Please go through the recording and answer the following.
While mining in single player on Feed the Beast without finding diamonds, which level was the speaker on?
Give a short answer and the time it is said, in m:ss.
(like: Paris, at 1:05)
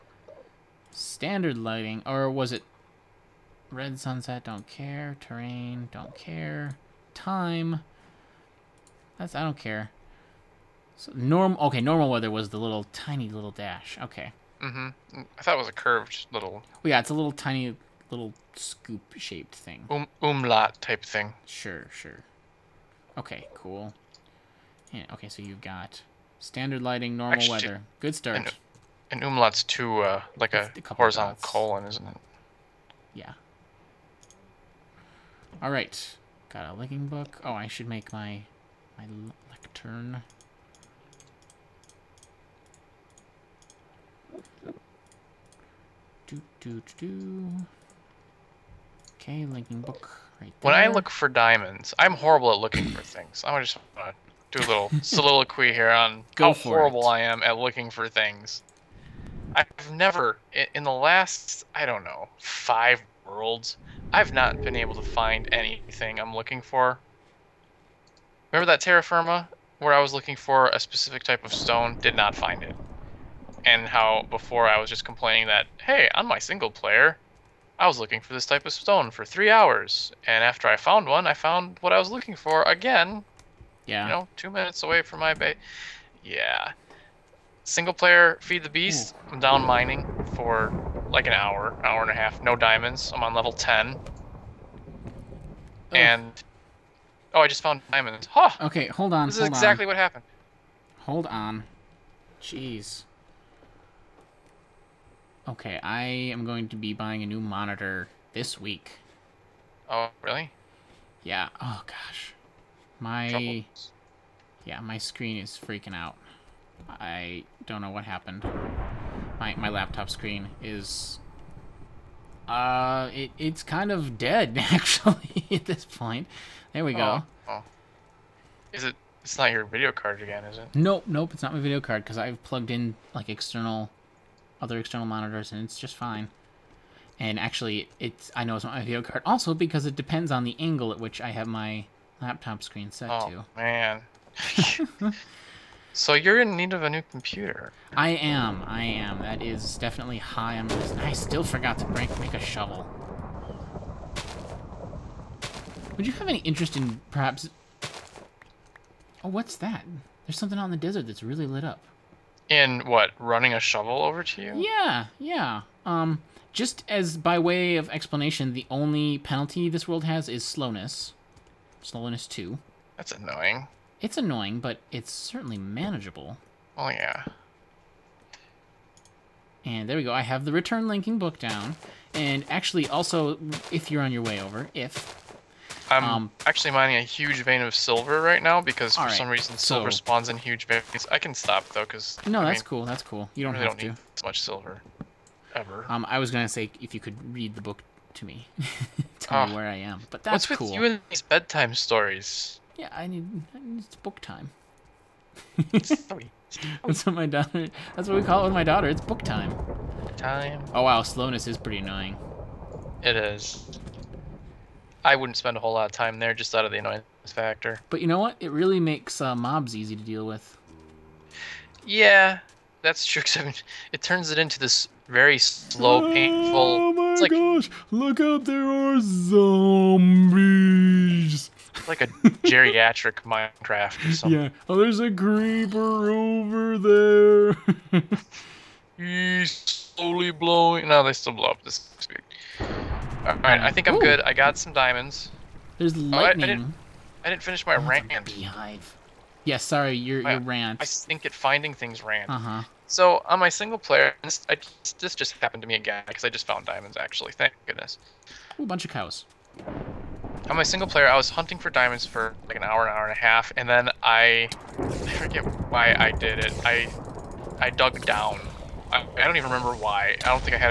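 10, at 1:33.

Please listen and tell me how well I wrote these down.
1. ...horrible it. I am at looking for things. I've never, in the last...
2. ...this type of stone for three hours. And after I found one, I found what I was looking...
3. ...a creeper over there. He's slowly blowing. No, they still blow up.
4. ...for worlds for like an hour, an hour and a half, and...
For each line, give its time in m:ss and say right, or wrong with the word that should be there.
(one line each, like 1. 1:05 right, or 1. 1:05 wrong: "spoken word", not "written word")
1. 0:56 right
2. 1:18 right
3. 3:55 right
4. 4:21 wrong: "diamonds", not "worlds".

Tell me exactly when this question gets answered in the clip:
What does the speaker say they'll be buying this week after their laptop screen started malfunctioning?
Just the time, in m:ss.
1:47.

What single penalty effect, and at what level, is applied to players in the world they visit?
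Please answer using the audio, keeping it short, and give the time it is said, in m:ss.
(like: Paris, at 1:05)
Slowness 2, at 2:51.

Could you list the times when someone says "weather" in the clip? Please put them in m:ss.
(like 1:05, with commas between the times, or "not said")
0:12, 0:27.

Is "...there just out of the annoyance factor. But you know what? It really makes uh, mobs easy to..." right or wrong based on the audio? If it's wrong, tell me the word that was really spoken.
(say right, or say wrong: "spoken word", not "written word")
right.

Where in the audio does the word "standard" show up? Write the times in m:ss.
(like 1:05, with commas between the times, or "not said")
0:00, 0:26.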